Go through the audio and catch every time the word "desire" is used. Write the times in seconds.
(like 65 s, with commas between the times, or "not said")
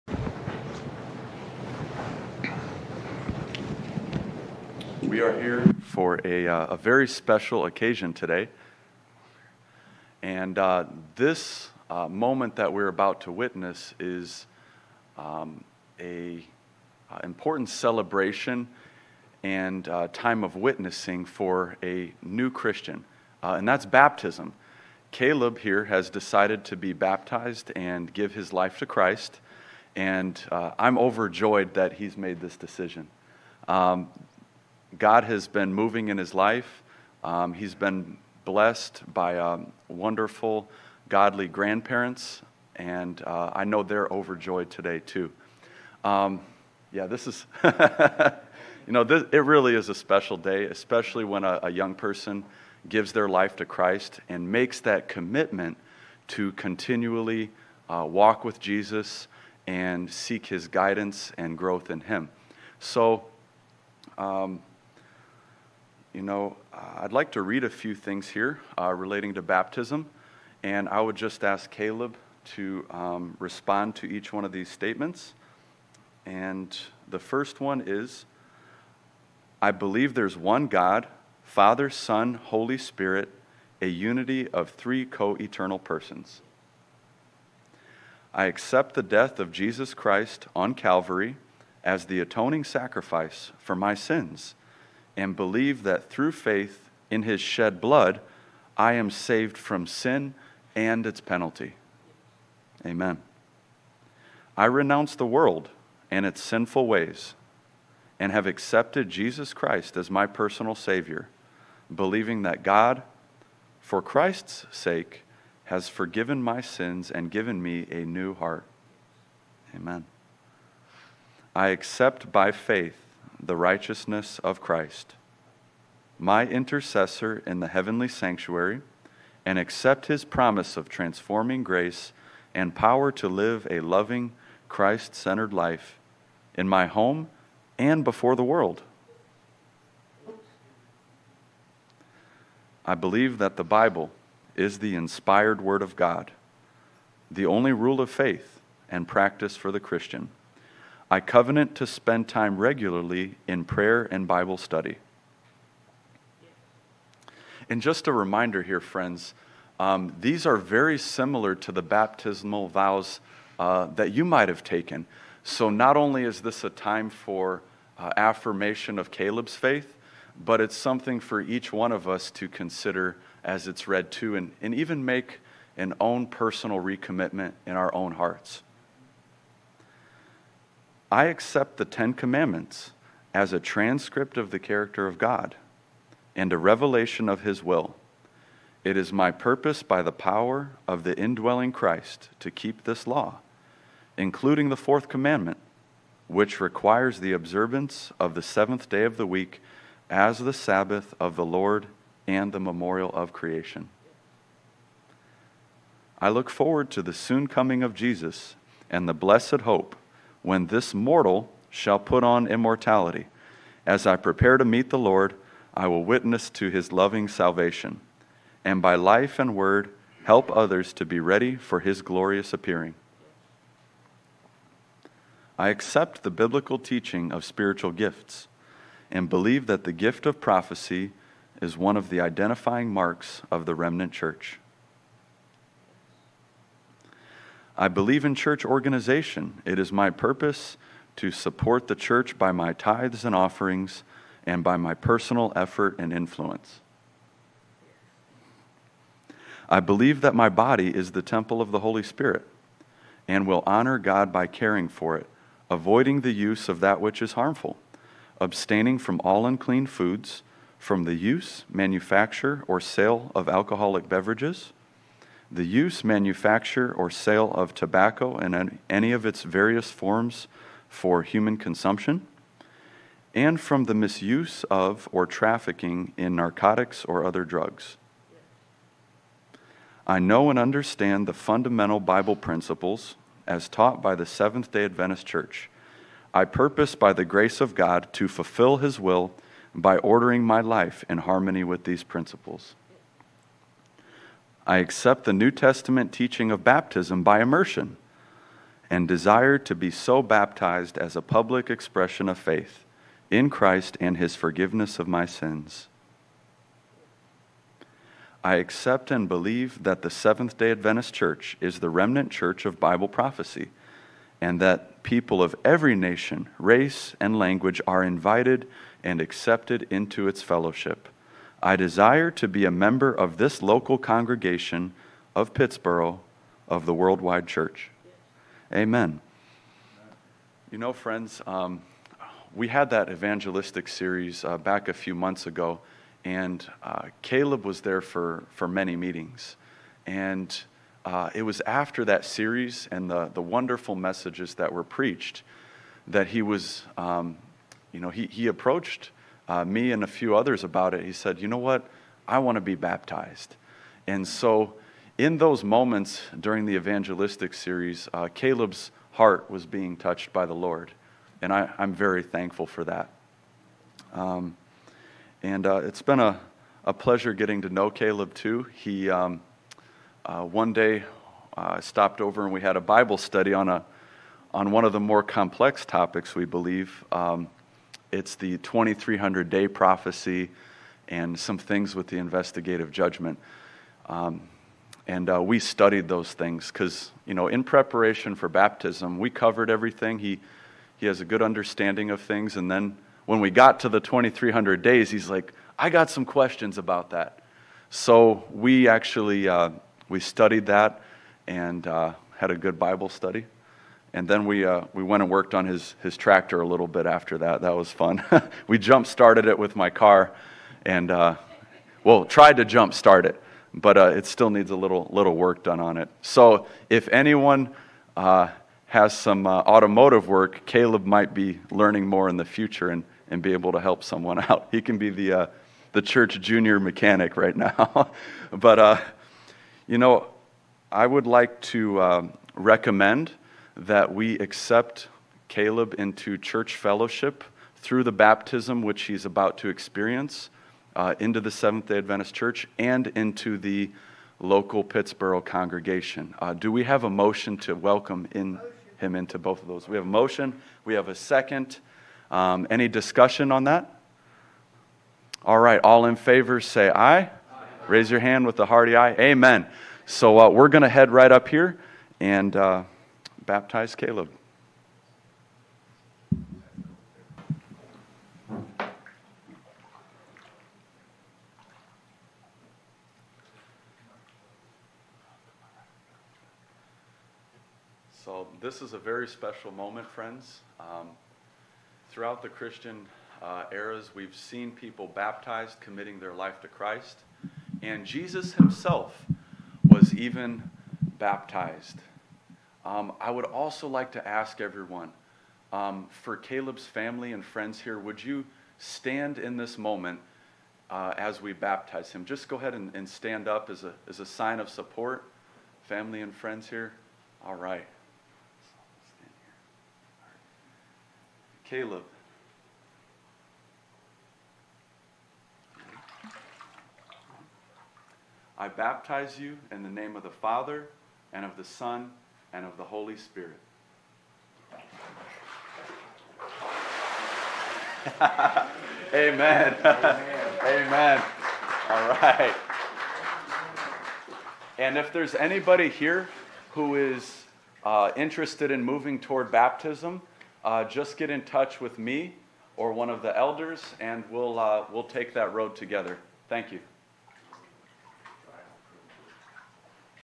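299 s, 321 s.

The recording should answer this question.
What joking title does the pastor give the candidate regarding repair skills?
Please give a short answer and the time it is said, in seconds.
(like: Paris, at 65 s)
Church junior mechanic, at 426 s.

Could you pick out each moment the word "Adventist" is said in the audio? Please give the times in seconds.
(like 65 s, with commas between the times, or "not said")
284 s, 310 s, 441 s.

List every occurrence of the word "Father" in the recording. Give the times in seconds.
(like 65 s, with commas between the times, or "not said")
81 s, 520 s.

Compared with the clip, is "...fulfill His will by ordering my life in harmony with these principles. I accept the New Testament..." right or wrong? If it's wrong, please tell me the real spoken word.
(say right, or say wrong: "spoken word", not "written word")
right.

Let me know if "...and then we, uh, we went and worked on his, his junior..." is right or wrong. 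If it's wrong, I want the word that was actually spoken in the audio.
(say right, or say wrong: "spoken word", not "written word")
wrong: "tractor", not "junior".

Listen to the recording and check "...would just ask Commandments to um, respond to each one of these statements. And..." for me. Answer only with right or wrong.
wrong.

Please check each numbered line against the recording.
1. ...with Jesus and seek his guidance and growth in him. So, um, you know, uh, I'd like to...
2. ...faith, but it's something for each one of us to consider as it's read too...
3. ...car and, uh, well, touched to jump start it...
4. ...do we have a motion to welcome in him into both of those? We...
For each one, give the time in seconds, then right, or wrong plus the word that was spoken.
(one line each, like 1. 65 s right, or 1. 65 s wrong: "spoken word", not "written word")
1. 58 s right
2. 169 s right
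3. 409 s wrong: "tried", not "touched"
4. 446 s right.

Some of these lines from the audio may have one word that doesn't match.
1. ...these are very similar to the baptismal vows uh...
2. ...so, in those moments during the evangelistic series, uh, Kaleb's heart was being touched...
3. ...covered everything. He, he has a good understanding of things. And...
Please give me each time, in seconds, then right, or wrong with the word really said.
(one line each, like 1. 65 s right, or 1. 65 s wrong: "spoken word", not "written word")
1. 160 s right
2. 354 s right
3. 389 s right.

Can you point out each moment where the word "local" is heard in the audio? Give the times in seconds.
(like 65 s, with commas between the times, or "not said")
323 s, 444 s.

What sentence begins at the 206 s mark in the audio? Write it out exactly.
I look forward to the soon coming of Jesus and the blessed hope when this mortal shall put on immortality.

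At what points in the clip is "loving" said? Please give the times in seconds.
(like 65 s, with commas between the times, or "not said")
133 s, 216 s.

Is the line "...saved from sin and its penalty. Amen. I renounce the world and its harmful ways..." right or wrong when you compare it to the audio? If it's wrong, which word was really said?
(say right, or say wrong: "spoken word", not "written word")
wrong: "sinful", not "harmful".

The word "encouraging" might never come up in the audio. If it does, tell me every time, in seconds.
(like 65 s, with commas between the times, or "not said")
not said.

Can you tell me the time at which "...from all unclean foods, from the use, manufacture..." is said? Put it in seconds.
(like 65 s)
258 s.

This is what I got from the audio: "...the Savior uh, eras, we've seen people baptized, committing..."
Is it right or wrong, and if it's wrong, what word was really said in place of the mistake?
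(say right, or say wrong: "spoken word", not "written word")
wrong: "Christian", not "Savior".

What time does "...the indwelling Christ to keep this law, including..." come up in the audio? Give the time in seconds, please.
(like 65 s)
191 s.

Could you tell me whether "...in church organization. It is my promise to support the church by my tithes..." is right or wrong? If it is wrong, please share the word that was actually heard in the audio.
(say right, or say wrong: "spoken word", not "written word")
wrong: "purpose", not "promise".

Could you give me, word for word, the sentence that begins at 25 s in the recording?
Kaleb here has decided to be baptized and give his life to Christ, and I'm overjoyed that he's made this decision.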